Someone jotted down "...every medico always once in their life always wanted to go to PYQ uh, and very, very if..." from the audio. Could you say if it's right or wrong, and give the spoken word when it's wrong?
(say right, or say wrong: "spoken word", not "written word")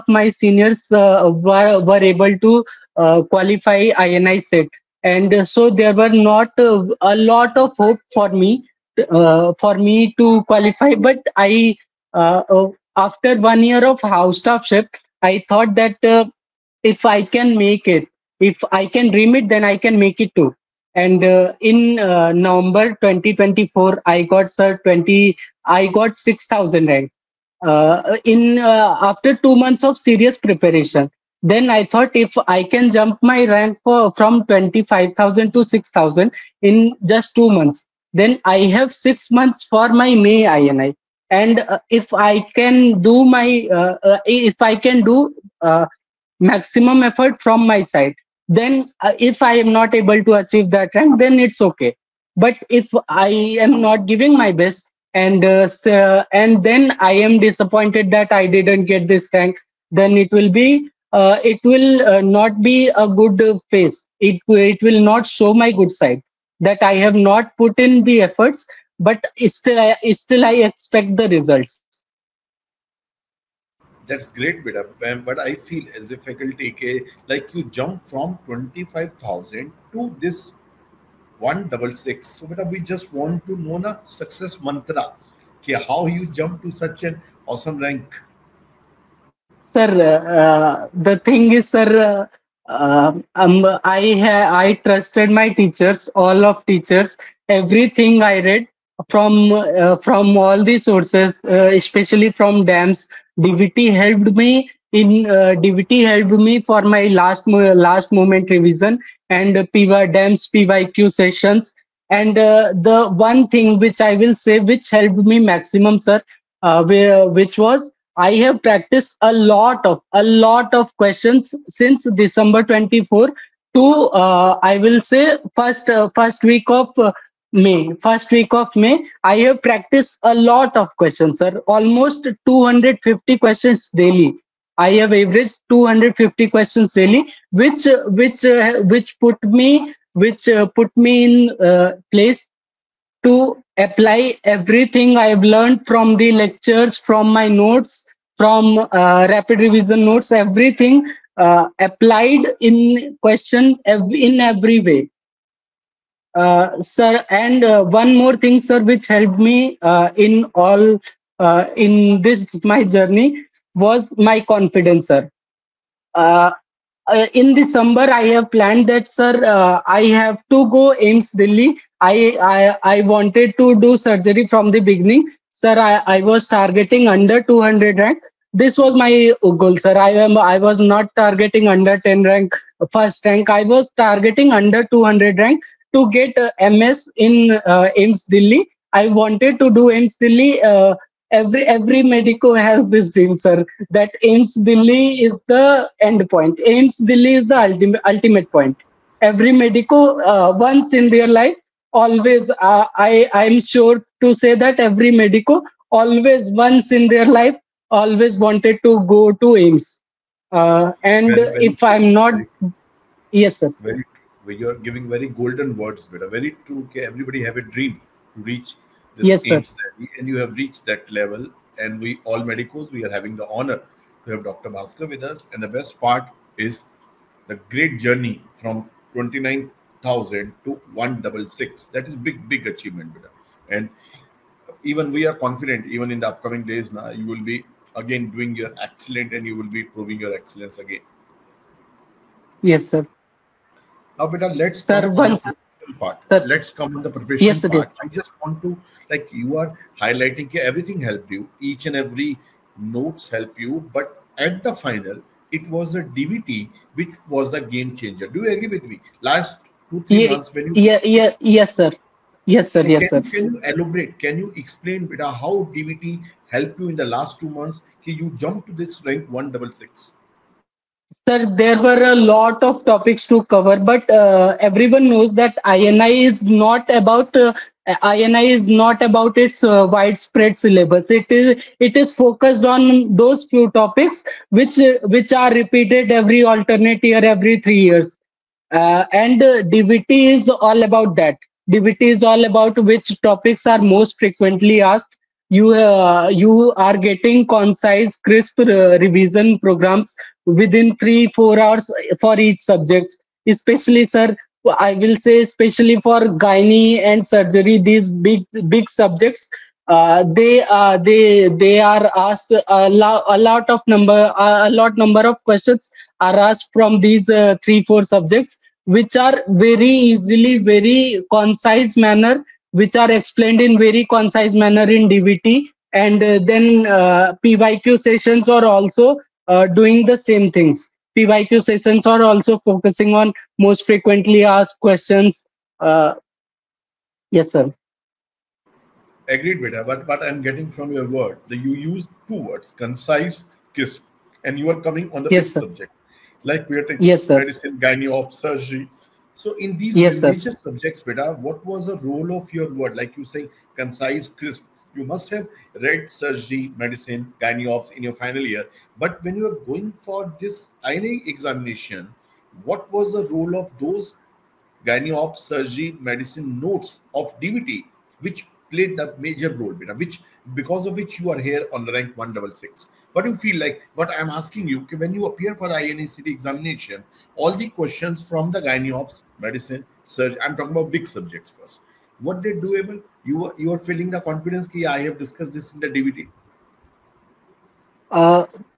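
wrong: "AIIMS", not "PYQ".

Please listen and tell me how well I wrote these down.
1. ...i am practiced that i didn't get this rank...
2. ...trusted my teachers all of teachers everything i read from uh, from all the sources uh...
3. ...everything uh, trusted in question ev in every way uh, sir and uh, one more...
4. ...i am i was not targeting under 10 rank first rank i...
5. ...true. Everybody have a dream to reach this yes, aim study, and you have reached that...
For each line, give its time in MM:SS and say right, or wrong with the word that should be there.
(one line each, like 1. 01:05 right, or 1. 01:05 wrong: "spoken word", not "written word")
1. 00:57 wrong: "disappointed", not "practiced"
2. 01:34 right
3. 02:30 wrong: "applied", not "trusted"
4. 02:59 right
5. 03:36 right.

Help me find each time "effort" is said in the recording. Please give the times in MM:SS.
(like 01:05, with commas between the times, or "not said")
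00:47, 01:08.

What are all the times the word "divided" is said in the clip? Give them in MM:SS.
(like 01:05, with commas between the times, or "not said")
not said.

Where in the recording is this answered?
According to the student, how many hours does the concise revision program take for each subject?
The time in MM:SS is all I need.
05:00.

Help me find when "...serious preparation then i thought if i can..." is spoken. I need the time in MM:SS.
00:29.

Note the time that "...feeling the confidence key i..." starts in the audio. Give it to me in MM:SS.
06:23.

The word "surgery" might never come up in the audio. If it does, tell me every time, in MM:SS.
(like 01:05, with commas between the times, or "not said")
02:53, 05:07, 05:48, 05:56, 06:05, 06:20.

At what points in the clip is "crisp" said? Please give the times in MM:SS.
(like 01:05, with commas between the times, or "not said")
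04:58, 05:43, 05:54.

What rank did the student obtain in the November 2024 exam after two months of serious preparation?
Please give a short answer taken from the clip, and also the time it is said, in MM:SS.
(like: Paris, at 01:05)
6000, at 00:26.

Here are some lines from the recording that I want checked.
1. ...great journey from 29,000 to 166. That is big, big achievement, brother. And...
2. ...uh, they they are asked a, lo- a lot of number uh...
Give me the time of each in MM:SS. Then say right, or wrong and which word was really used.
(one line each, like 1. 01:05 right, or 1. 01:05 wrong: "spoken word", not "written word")
1. 03:47 right
2. 05:10 right.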